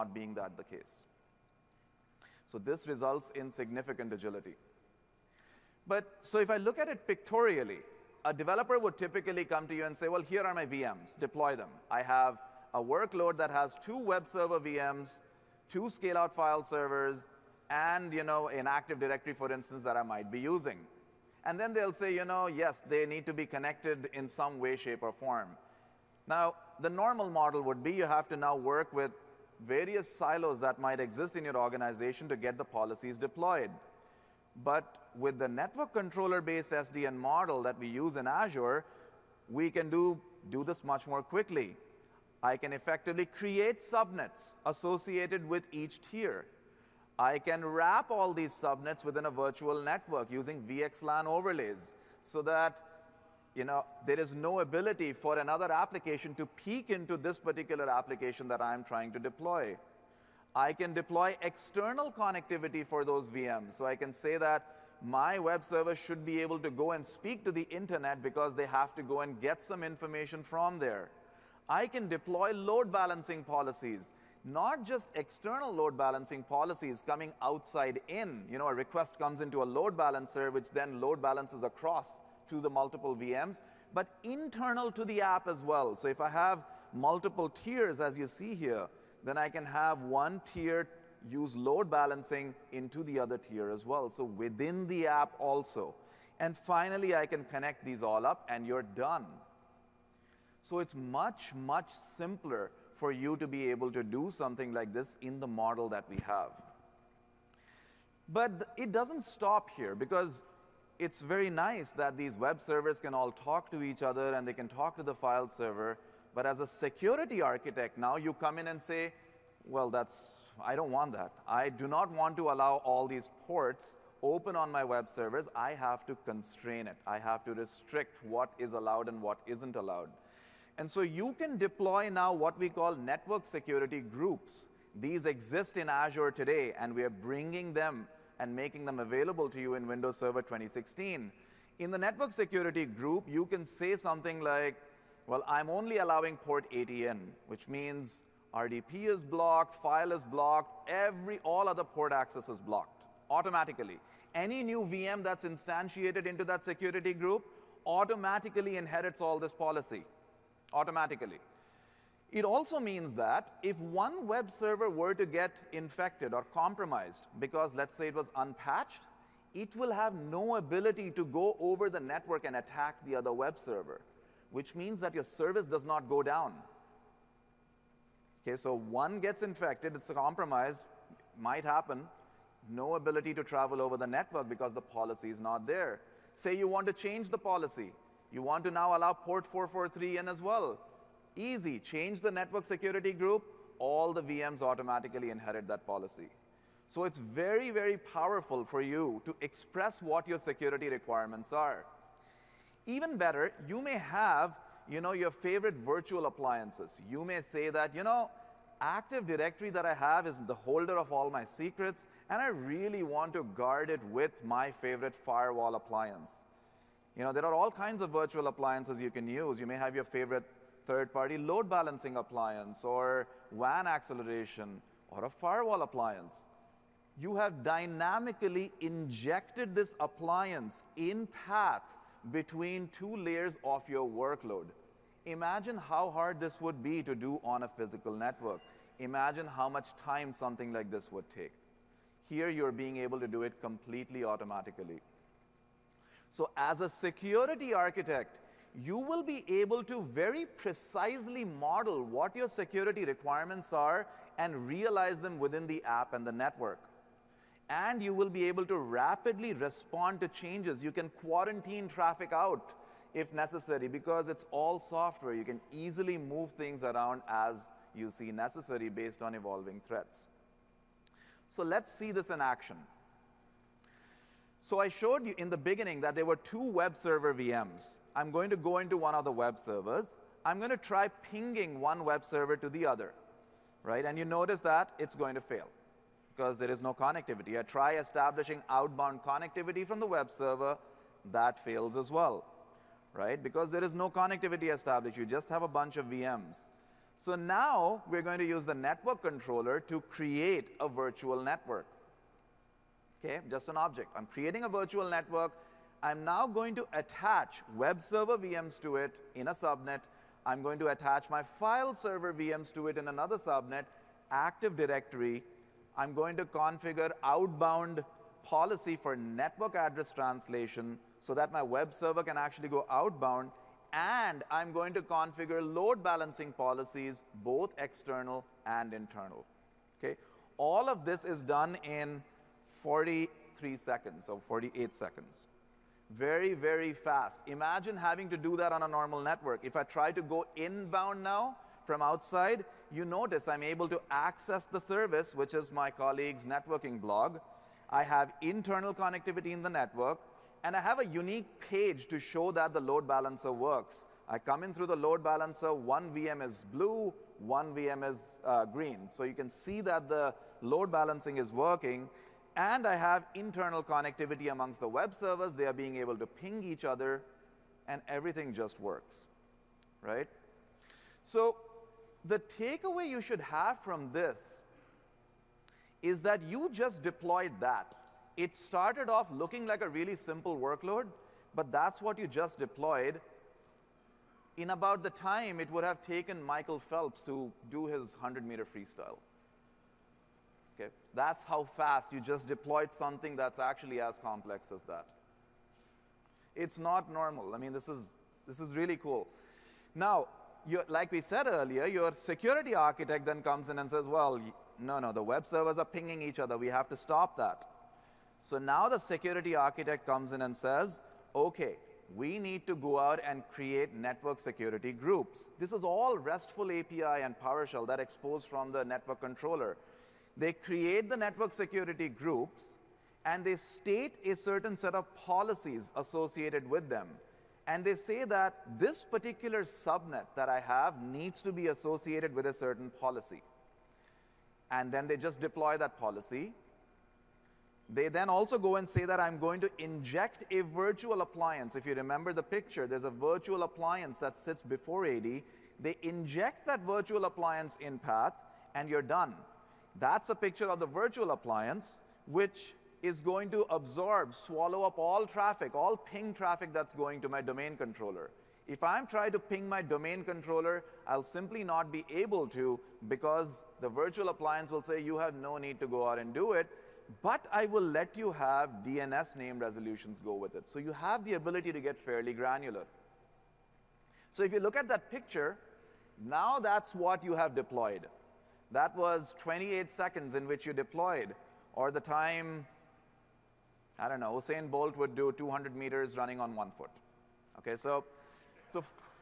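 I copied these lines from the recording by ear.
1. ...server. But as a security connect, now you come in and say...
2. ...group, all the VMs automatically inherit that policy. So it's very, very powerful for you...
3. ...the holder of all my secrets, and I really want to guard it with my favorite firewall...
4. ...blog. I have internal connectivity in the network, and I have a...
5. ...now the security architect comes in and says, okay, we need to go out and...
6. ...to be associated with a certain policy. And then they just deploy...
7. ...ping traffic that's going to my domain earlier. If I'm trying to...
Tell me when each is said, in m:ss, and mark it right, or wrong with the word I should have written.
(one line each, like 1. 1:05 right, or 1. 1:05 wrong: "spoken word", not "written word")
1. 1:55 wrong: "architect", not "connect"
2. 3:13 right
3. 3:30 right
4. 5:47 right
5. 6:48 right
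6. 7:11 right
7. 7:35 wrong: "controller", not "earlier".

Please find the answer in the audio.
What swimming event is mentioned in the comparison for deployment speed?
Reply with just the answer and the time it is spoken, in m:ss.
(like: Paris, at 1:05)
100 meter freestyle, at 6:28.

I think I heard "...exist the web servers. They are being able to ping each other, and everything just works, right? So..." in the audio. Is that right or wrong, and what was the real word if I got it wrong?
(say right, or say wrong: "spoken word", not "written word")
wrong: "amongst", not "exist".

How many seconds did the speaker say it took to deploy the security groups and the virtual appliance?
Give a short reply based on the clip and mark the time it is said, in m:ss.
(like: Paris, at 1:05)
28, at 7:59.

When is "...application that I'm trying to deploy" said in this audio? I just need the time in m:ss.
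0:57.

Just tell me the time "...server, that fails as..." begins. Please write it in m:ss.
4:50.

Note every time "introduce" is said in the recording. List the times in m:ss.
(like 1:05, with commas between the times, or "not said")
not said.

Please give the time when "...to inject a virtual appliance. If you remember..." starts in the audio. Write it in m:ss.
7:19.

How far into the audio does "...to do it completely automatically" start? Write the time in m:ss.
4:03.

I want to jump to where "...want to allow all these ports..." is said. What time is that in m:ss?
2:02.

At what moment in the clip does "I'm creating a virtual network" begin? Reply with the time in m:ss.
5:04.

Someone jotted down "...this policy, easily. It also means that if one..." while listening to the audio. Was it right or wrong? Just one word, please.
wrong.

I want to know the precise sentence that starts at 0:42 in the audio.
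I can effectively create subnets associated with each tier.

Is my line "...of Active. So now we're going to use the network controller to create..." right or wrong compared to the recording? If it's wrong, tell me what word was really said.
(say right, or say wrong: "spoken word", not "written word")
wrong: "VMs", not "Active".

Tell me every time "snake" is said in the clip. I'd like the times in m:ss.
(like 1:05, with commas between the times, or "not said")
not said.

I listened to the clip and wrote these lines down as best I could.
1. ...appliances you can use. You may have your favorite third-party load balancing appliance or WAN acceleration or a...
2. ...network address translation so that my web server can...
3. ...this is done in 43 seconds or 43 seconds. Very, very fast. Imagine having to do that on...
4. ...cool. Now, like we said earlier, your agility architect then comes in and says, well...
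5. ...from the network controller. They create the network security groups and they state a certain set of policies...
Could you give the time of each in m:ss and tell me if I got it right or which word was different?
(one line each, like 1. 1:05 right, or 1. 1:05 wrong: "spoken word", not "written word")
1. 3:38 right
2. 5:19 right
3. 5:31 wrong: "48", not "43"
4. 6:38 wrong: "security", not "agility"
5. 6:58 right.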